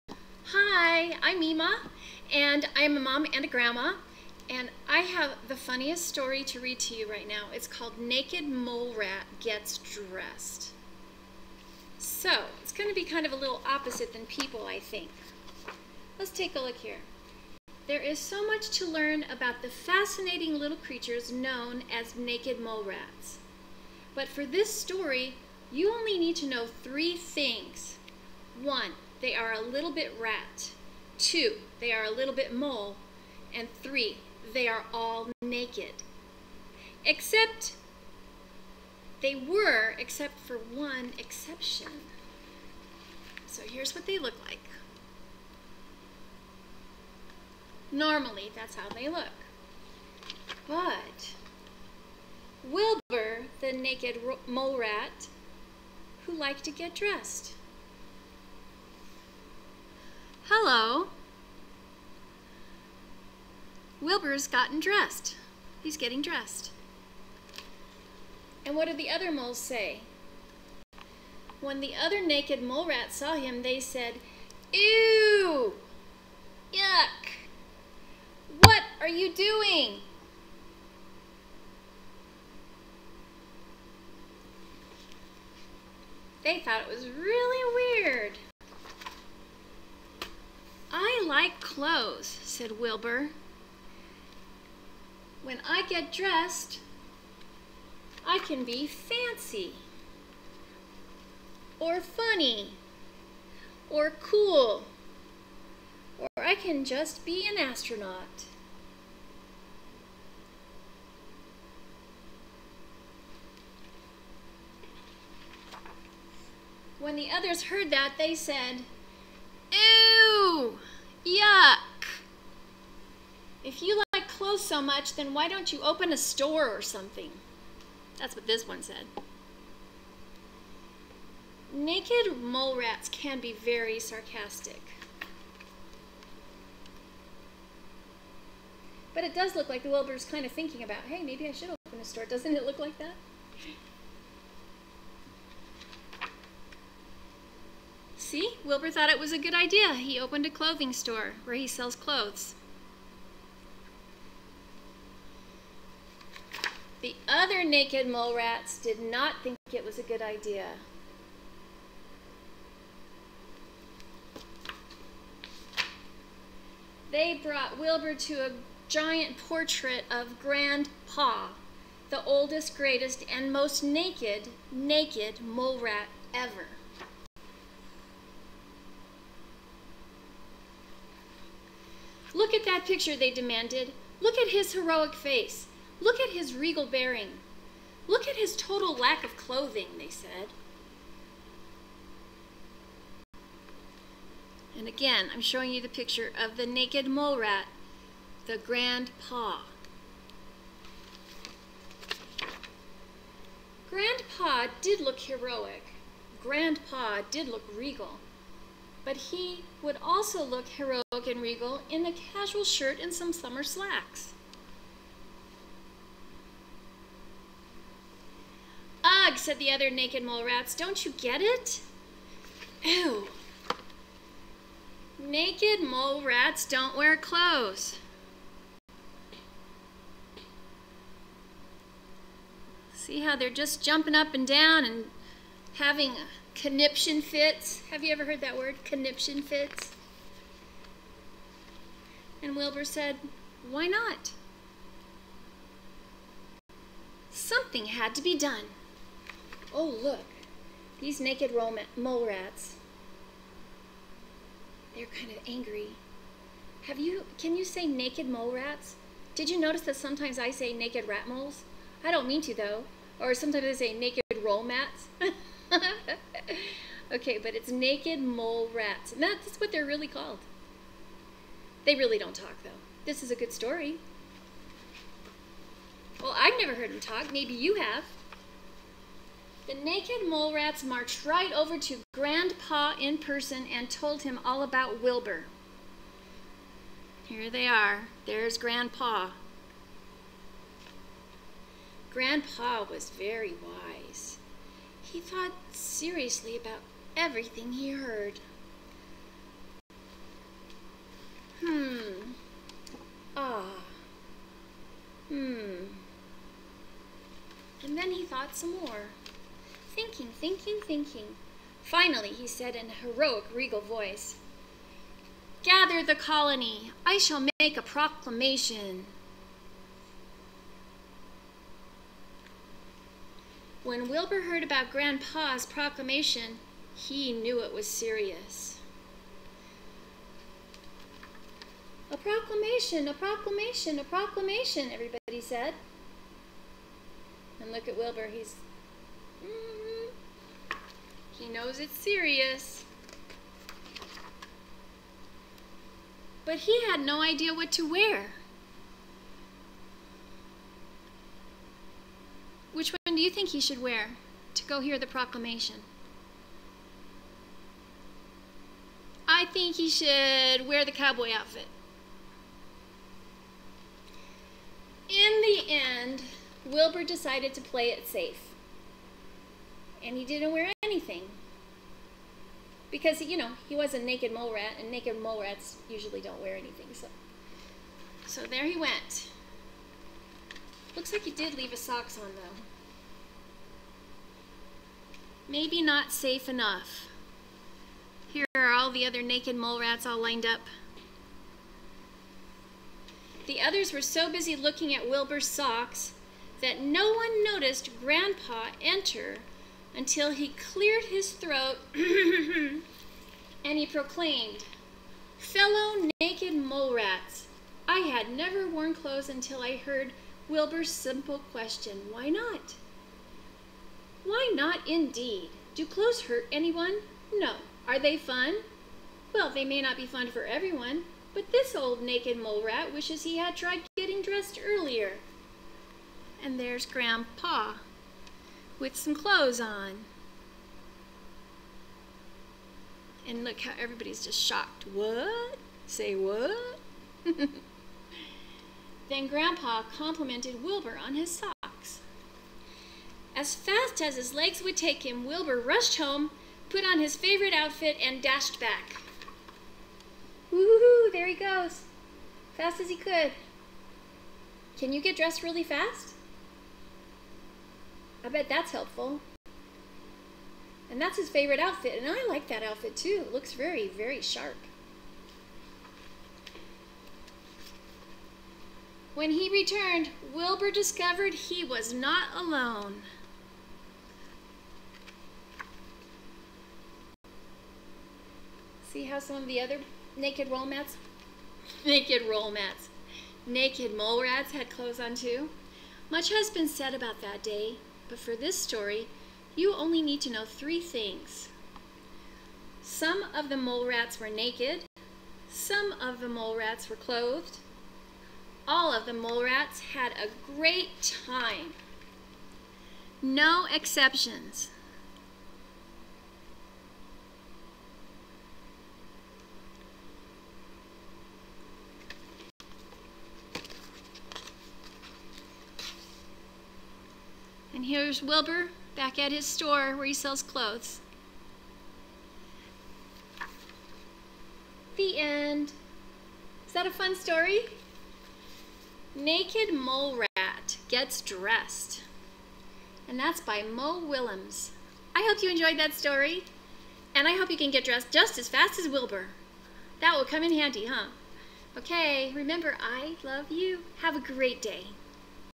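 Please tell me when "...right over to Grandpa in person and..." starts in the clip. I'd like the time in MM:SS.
04:41.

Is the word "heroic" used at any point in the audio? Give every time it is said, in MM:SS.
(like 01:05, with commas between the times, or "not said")
03:04, 03:25, 03:30, 05:13.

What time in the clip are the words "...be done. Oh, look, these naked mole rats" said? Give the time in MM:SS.
04:08.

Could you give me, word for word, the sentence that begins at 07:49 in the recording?
When he returned, Wilbur discovered he was not alone.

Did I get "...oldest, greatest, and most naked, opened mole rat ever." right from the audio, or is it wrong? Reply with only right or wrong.
wrong.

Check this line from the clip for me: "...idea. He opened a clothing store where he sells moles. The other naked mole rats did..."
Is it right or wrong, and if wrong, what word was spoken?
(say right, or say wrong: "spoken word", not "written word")
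wrong: "clothes", not "moles".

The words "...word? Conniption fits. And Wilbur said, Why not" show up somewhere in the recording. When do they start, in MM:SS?
03:58.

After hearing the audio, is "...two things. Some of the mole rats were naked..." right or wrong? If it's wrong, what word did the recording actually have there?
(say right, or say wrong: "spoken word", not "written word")
wrong: "three", not "two".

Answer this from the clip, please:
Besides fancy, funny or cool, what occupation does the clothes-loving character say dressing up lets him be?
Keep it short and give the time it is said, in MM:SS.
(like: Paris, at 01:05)
Astronaut, at 01:47.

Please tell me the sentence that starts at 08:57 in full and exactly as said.
And I hope you can get dressed just as fast as Wilbur.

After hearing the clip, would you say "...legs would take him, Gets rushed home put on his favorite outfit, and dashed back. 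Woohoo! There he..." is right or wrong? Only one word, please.
wrong.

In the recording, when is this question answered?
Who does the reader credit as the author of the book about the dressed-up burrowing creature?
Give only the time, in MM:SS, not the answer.
08:53.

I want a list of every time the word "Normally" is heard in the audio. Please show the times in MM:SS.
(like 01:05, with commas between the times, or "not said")
00:47.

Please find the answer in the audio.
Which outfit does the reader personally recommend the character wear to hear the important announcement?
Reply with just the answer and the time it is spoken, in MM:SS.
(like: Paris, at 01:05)
The cowboy outfit, at 06:00.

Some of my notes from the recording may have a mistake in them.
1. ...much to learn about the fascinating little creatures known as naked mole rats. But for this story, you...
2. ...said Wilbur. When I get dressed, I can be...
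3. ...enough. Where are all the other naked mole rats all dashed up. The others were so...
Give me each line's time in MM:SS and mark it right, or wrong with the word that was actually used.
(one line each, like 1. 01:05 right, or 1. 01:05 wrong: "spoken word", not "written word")
1. 00:18 right
2. 01:32 right
3. 06:26 wrong: "lined", not "dashed".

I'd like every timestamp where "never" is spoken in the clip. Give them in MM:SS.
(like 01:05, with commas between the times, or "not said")
04:36, 06:48.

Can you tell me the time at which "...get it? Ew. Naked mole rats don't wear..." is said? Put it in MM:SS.
03:41.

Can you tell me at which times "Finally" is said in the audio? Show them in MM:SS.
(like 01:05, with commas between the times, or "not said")
05:11.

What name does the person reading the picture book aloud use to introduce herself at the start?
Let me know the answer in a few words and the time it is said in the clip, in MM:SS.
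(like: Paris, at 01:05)
Mima, at 00:01.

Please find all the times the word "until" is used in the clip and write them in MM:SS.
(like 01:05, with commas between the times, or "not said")
06:39, 06:49.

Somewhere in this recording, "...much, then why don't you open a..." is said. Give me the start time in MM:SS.
02:04.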